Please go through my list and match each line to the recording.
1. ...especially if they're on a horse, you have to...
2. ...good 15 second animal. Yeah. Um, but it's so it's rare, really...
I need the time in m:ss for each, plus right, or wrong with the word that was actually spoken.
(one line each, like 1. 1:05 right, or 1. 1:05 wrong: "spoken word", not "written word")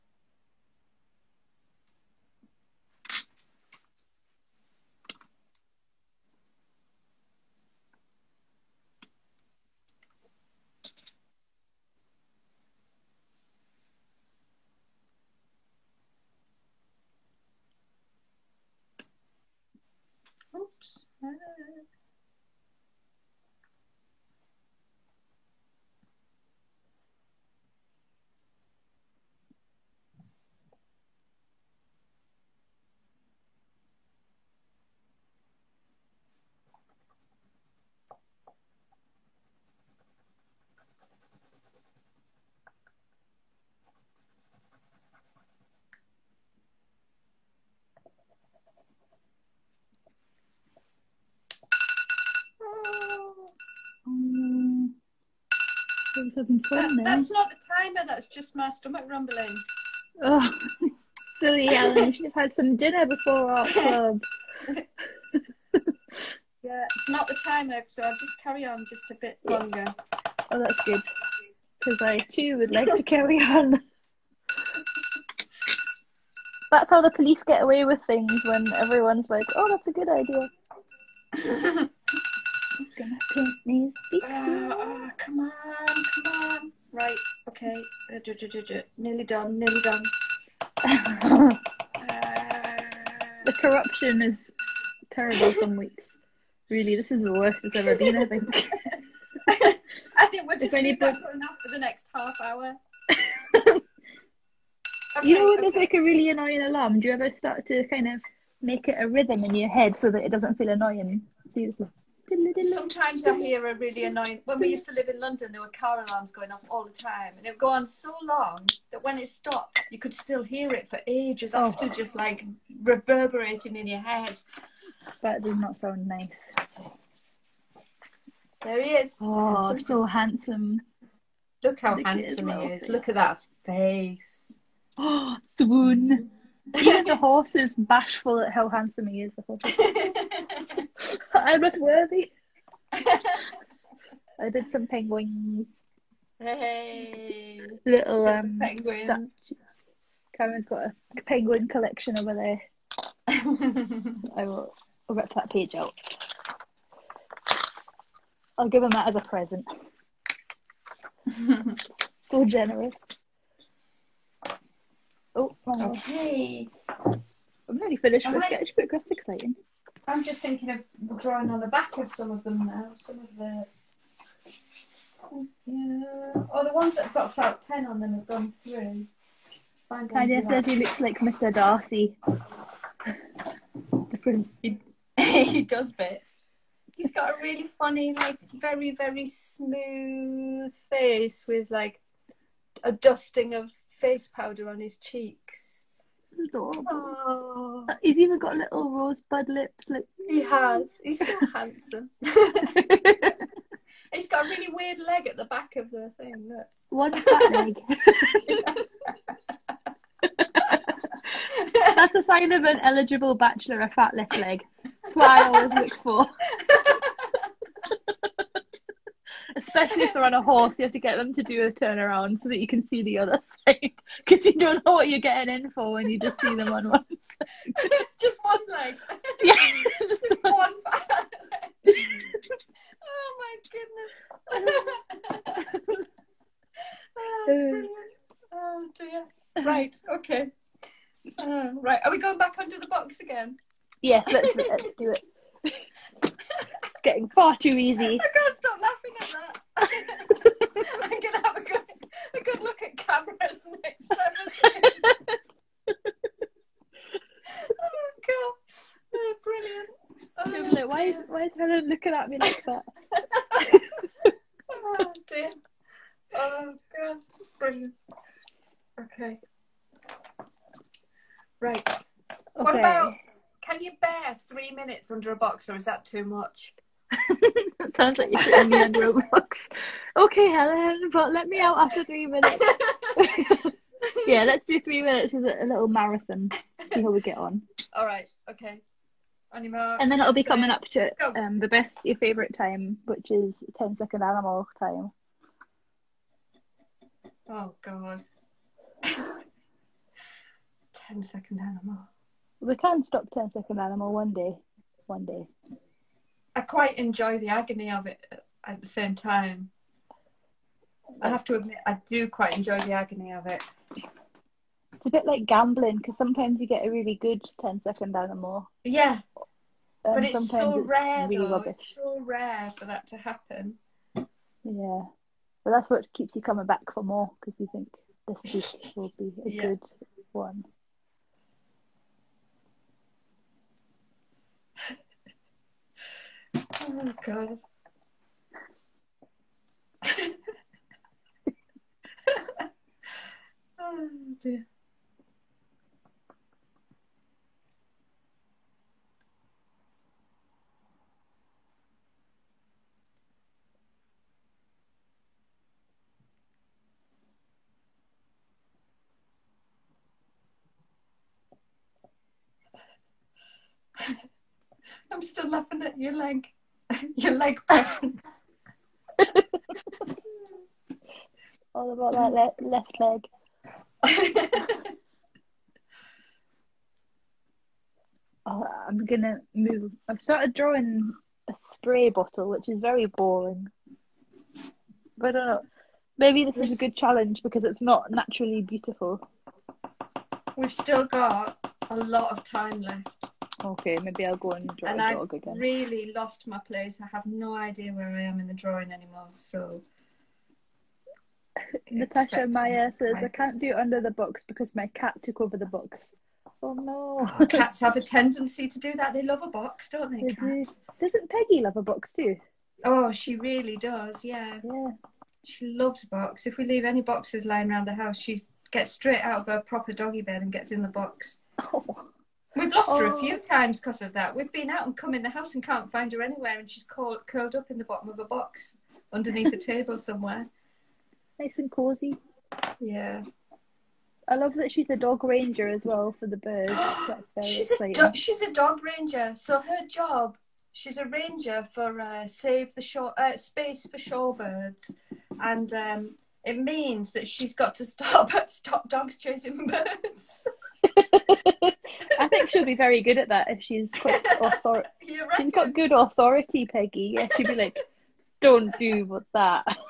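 1. 3:39 right
2. 5:17 wrong: "10", not "15".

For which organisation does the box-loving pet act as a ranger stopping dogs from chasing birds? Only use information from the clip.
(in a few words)
Space for Shorebirds.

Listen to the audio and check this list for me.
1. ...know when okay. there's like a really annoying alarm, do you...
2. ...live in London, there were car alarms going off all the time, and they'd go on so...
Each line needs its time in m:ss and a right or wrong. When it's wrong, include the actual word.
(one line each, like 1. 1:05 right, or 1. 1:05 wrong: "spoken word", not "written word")
1. 1:45 right
2. 1:54 right.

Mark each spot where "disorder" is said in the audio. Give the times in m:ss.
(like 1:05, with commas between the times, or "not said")
not said.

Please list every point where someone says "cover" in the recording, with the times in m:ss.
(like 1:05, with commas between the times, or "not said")
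not said.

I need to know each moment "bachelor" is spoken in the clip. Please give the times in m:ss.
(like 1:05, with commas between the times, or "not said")
3:33.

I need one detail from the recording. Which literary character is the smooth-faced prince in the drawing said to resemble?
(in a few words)
Mr. Darcy.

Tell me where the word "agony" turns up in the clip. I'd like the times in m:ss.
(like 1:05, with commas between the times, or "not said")
5:07, 5:12.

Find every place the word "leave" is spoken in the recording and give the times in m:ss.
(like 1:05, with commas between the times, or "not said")
1:40, 6:56.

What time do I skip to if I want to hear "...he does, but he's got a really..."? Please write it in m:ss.
3:05.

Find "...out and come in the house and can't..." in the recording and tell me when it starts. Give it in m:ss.
7:04.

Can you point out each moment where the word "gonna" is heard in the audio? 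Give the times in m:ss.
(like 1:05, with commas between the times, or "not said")
4:11, 6:19.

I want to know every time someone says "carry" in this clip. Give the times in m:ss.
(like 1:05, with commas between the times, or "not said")
1:08, 1:13.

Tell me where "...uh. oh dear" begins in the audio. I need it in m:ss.
3:57.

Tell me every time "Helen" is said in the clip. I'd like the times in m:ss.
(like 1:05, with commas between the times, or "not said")
4:21, 4:40.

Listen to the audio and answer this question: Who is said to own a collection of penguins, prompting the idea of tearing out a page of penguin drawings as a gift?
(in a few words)
Karen.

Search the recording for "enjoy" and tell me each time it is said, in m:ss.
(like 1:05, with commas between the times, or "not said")
5:06, 5:12.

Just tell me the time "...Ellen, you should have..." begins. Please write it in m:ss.
1:01.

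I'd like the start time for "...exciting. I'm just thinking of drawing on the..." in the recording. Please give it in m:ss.
2:49.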